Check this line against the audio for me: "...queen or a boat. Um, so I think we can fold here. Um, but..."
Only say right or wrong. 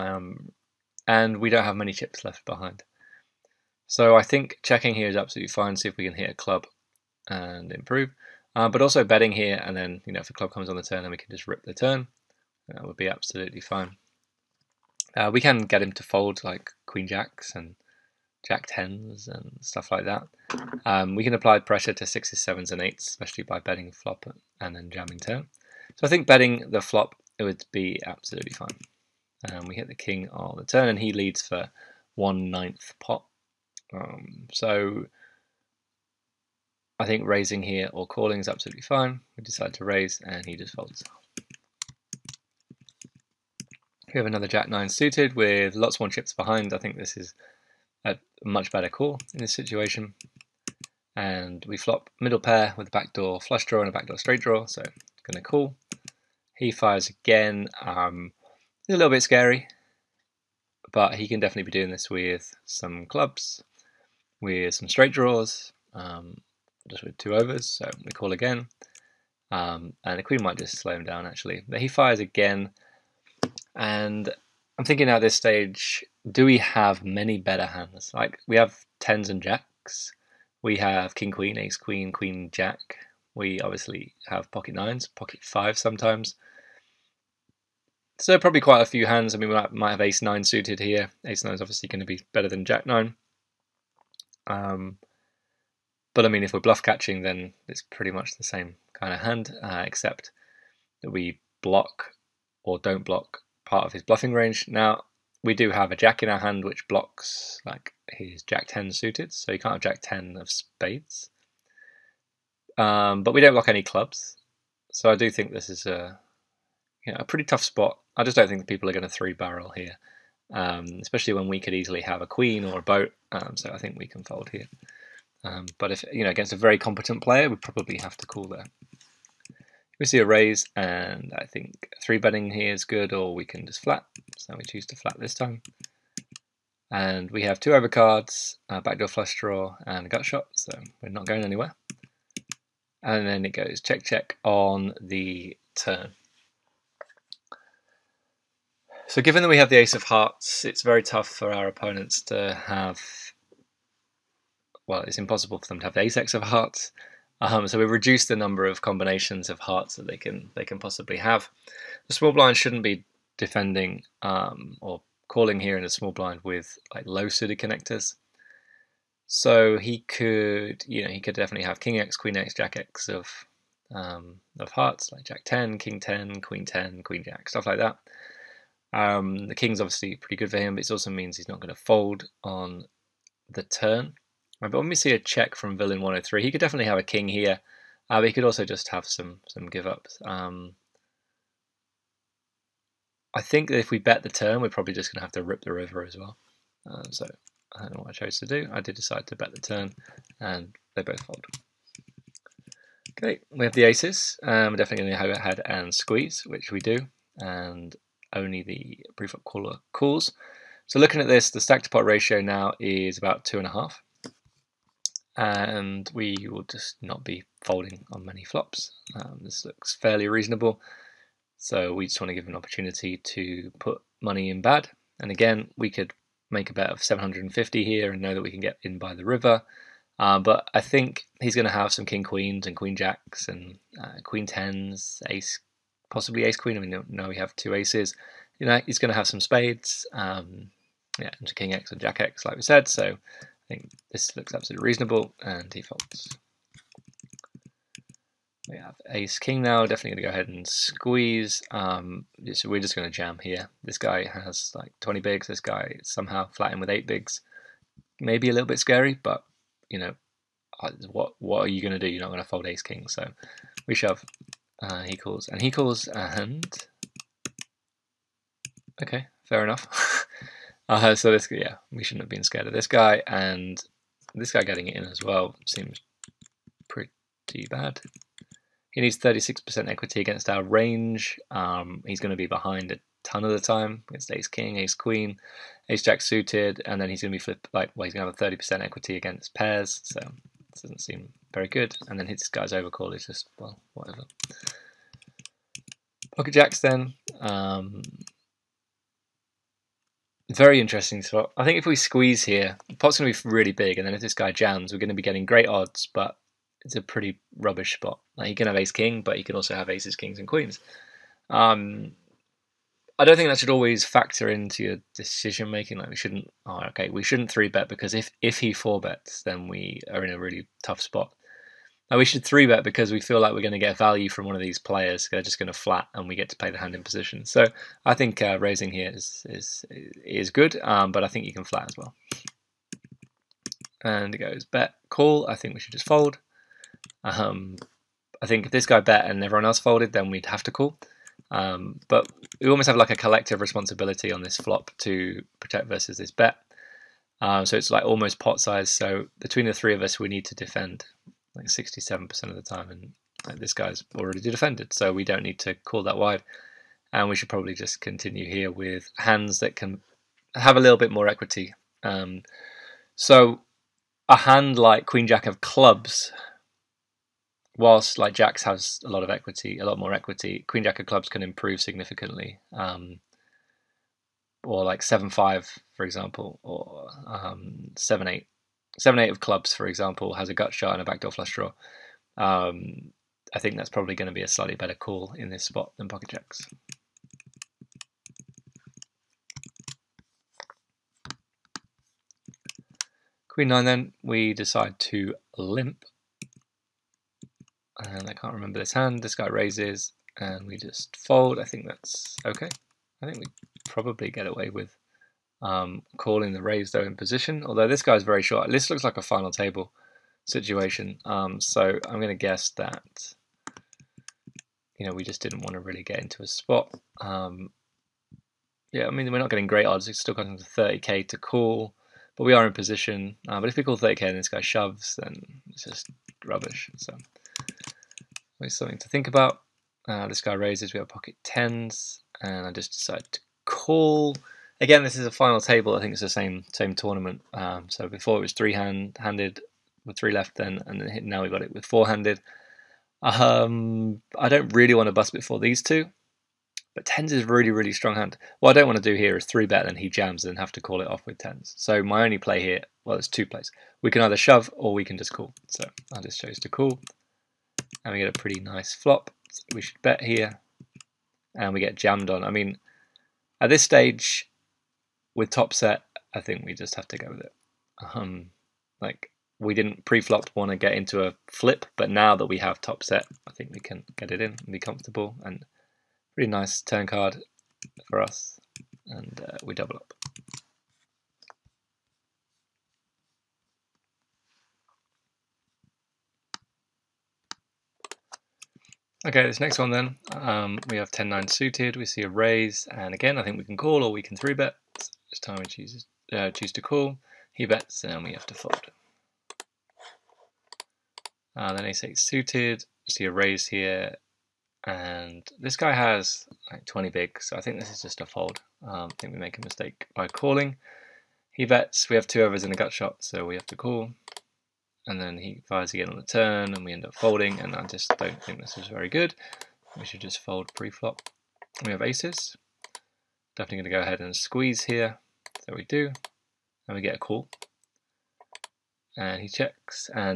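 right.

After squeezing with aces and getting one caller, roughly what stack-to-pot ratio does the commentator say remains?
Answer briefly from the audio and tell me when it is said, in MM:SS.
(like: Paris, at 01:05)
About 2.5, at 03:33.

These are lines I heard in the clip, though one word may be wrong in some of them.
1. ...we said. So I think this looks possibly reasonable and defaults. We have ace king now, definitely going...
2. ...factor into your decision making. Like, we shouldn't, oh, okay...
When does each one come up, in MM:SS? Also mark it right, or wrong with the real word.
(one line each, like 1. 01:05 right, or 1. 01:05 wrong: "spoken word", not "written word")
1. 04:02 wrong: "absolutely", not "possibly"
2. 05:14 right.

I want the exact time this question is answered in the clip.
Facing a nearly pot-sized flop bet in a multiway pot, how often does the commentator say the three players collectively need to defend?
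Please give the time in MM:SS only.
05:51.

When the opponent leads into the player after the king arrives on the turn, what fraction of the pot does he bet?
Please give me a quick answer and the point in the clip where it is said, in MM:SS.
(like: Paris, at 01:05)
1/9 pot, at 00:32.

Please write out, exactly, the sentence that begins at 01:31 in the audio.
Ace nine is obviously going to be better than jack nine.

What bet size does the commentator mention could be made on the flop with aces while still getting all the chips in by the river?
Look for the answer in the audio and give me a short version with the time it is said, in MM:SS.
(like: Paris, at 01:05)
750, at 03:47.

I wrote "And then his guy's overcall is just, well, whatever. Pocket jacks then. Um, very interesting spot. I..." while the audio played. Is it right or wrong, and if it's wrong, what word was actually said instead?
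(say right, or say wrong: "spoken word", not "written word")
right.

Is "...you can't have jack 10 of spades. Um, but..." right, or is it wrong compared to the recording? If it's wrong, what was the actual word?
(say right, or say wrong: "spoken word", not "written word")
right.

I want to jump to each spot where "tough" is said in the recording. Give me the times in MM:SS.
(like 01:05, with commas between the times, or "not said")
01:57, 02:31, 05:20.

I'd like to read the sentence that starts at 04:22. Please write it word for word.
You're not going to fold ace king, so we shove.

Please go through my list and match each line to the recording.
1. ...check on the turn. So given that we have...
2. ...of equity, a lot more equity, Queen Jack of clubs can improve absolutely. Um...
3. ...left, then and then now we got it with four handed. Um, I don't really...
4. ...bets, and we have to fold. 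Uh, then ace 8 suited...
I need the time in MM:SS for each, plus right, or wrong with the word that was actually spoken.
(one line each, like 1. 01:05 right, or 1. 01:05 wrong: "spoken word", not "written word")
1. 02:24 right
2. 06:09 wrong: "significantly", not "absolutely"
3. 07:20 right
4. 08:17 right.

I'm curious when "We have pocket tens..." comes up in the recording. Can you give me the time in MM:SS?
07:10.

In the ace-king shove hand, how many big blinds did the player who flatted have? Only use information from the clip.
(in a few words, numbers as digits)
8 big blinds.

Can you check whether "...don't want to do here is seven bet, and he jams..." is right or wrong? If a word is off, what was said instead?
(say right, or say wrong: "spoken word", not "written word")
wrong: "three", not "seven".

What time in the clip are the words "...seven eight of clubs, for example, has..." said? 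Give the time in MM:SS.
06:18.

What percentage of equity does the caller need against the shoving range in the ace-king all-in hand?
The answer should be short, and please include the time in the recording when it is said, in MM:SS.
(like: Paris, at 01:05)
36%, at 04:39.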